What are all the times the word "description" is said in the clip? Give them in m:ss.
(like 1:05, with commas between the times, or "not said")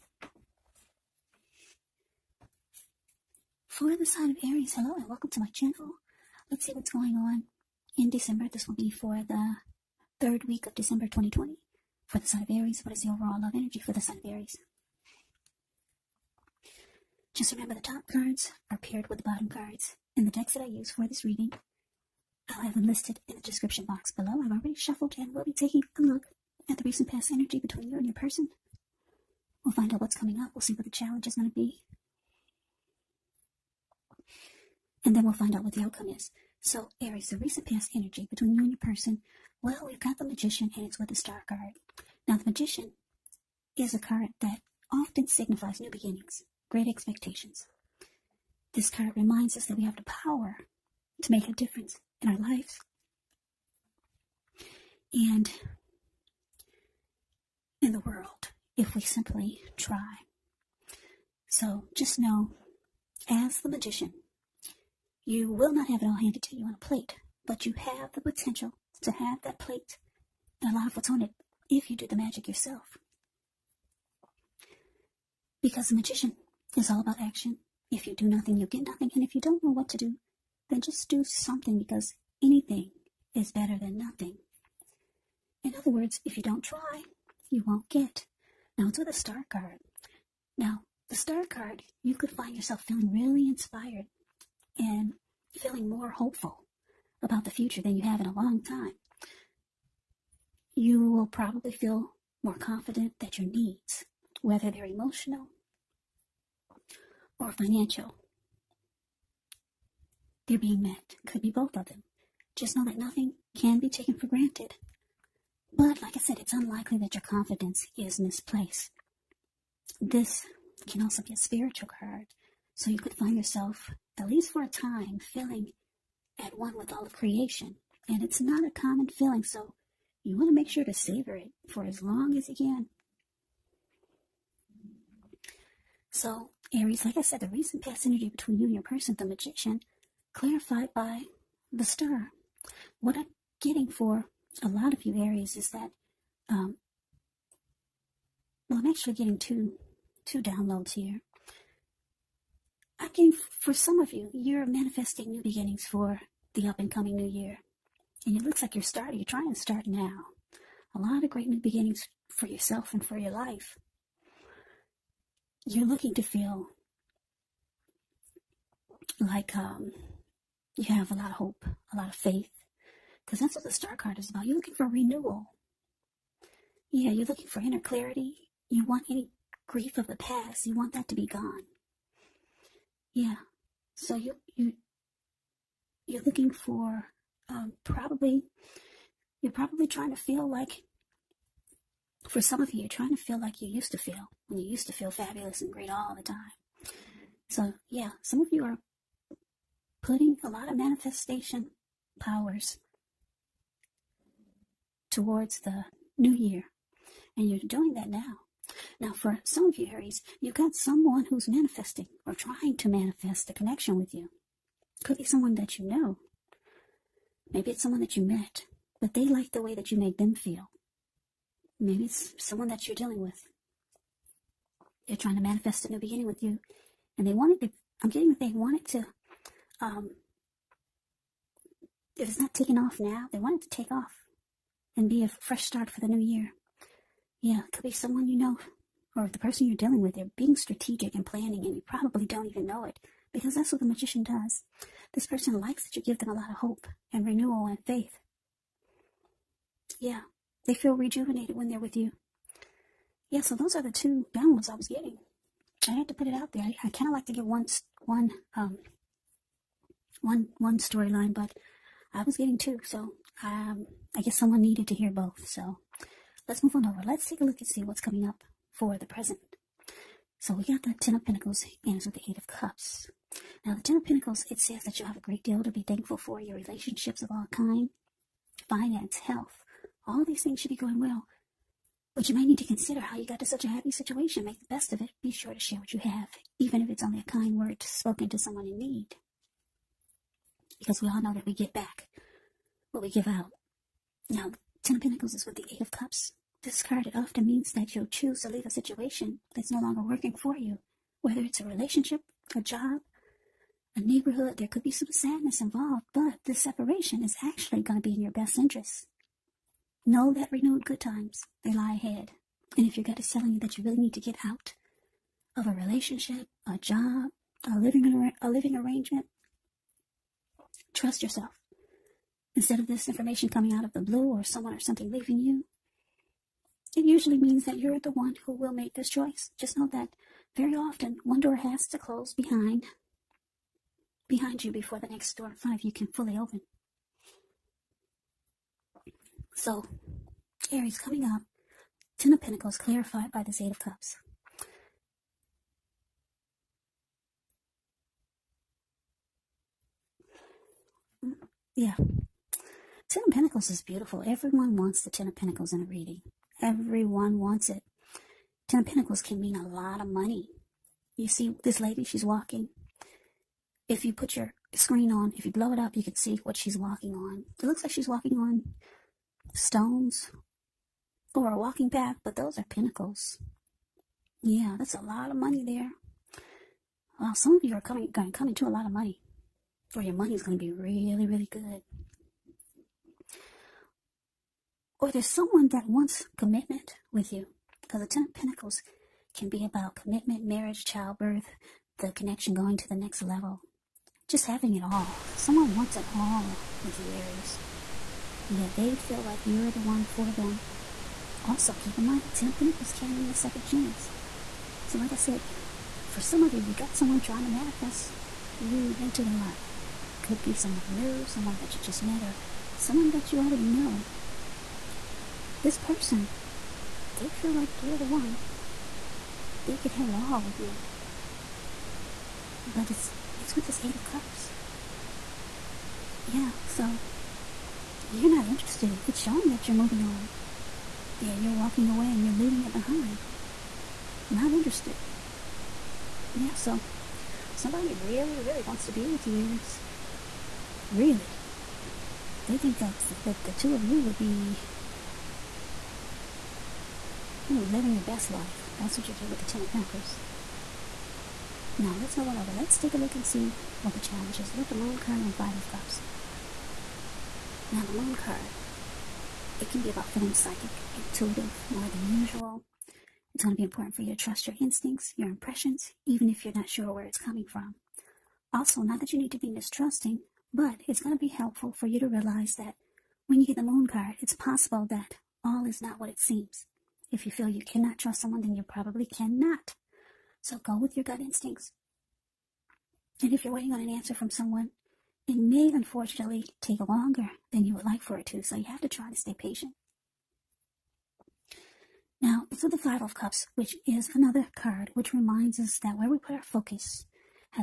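0:23.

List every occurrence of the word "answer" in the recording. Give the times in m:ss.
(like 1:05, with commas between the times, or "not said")
8:03.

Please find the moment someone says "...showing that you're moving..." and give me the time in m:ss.
7:09.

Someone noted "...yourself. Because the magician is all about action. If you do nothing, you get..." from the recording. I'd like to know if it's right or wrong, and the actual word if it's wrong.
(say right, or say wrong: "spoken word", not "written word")
right.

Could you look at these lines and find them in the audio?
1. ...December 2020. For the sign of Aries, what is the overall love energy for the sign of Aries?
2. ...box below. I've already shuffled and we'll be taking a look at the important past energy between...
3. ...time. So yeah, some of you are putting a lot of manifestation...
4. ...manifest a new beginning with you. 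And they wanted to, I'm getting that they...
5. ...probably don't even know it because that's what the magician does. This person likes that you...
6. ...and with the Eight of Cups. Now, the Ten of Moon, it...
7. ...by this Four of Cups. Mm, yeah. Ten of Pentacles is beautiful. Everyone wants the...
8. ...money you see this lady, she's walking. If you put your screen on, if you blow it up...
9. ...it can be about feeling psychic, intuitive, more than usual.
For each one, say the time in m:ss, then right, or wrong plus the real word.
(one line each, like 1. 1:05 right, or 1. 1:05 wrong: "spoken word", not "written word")
1. 0:10 right
2. 0:23 wrong: "recent", not "important"
3. 3:16 right
4. 3:45 right
5. 4:01 right
6. 4:31 wrong: "Pentacles", not "Moon"
7. 5:43 wrong: "Eight", not "Four"
8. 6:00 right
9. 7:39 right.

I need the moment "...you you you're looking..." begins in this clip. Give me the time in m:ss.
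3:04.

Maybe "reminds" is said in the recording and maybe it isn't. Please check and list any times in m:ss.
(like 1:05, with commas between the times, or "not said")
0:49, 8:15.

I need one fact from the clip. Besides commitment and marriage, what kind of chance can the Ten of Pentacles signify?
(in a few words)
a second chance.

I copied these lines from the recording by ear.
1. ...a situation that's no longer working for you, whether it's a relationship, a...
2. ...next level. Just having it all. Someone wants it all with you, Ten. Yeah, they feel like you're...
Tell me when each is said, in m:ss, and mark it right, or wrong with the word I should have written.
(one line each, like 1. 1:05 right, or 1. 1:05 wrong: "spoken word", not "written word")
1. 4:58 right
2. 6:32 wrong: "Aries", not "Ten".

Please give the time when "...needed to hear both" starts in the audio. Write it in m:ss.
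4:24.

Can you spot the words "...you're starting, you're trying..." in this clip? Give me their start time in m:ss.
2:38.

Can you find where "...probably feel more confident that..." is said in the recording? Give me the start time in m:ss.
1:41.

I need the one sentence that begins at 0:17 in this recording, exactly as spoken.
Just remember the top cards are paired with the bottom cards.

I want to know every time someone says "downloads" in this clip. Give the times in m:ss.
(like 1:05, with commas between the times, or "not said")
2:30, 4:14.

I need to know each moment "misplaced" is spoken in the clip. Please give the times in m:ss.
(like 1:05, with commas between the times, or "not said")
1:58.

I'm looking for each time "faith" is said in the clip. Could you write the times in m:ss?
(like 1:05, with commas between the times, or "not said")
2:52, 4:07.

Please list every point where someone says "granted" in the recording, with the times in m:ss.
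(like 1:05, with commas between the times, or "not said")
1:54.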